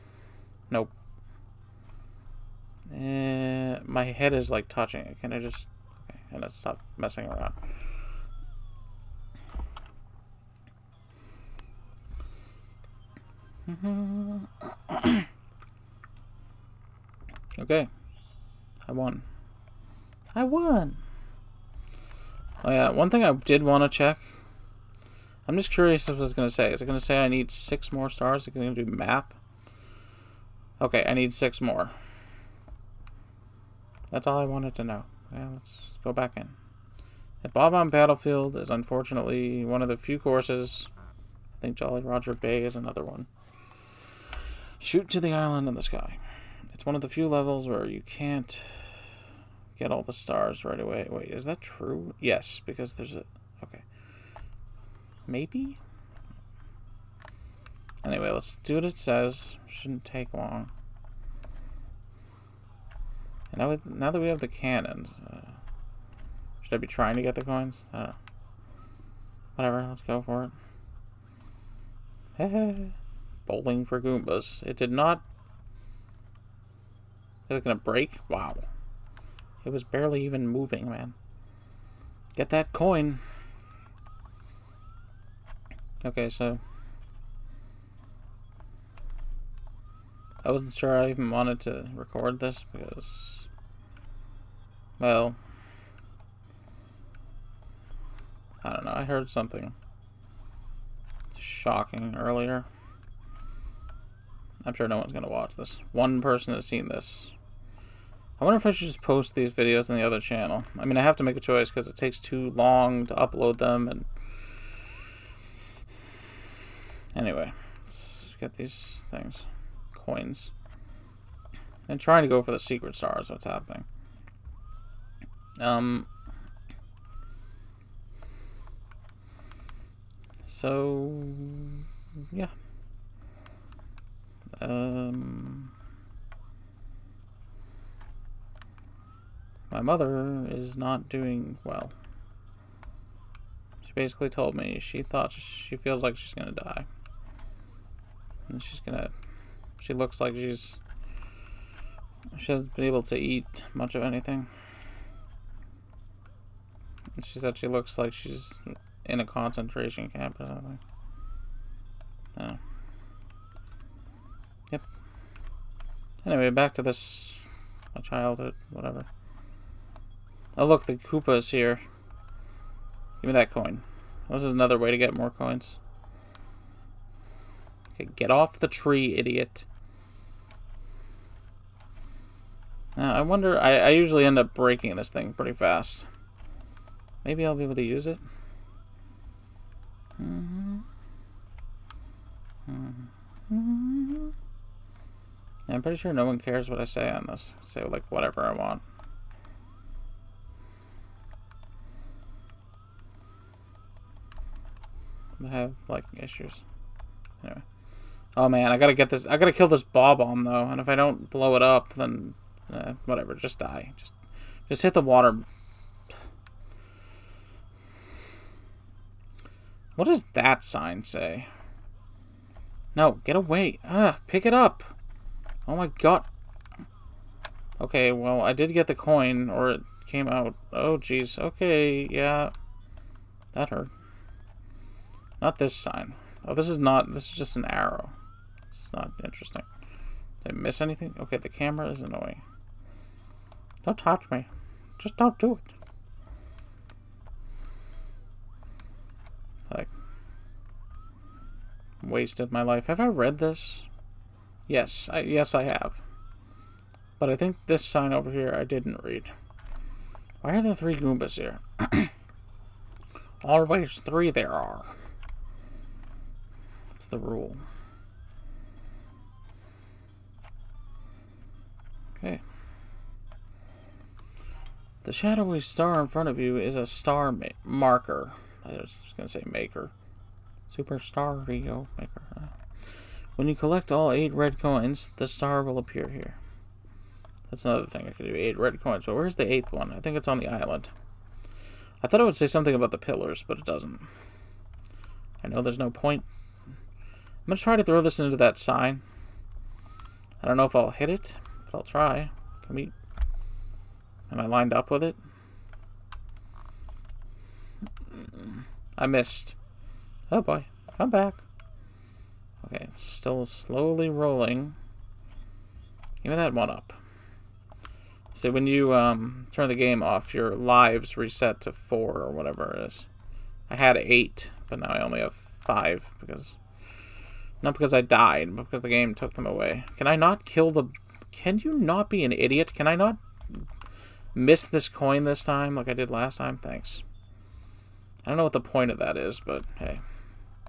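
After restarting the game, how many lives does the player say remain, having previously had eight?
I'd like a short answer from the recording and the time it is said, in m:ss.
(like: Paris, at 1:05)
5, at 5:25.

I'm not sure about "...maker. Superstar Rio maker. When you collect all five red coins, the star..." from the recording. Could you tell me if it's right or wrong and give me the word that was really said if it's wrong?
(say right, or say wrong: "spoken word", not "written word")
wrong: "eight", not "five".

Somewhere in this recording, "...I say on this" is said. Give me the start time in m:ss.
3:16.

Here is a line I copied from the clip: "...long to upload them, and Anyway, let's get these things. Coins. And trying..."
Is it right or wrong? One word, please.
right.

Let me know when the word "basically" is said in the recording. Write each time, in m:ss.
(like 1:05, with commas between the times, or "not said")
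2:23.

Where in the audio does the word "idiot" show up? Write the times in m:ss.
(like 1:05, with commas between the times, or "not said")
2:59, 5:32.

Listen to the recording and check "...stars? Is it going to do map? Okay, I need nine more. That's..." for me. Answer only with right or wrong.
wrong.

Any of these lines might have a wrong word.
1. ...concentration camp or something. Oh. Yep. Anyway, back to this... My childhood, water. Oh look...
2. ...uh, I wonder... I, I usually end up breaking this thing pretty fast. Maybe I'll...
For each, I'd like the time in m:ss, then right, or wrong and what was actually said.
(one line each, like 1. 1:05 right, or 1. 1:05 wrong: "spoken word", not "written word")
1. 2:39 wrong: "whatever", not "water"
2. 3:03 right.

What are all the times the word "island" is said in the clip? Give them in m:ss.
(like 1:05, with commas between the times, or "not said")
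0:45, 4:50.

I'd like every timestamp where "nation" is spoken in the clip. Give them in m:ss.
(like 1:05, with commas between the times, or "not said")
not said.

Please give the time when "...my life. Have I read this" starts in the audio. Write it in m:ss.
4:12.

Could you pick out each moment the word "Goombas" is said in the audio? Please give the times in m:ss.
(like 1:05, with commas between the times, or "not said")
1:14, 4:20.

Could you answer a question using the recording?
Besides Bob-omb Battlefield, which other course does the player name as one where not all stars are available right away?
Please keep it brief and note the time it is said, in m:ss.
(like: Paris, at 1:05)
Jolly Roger Bay, at 0:41.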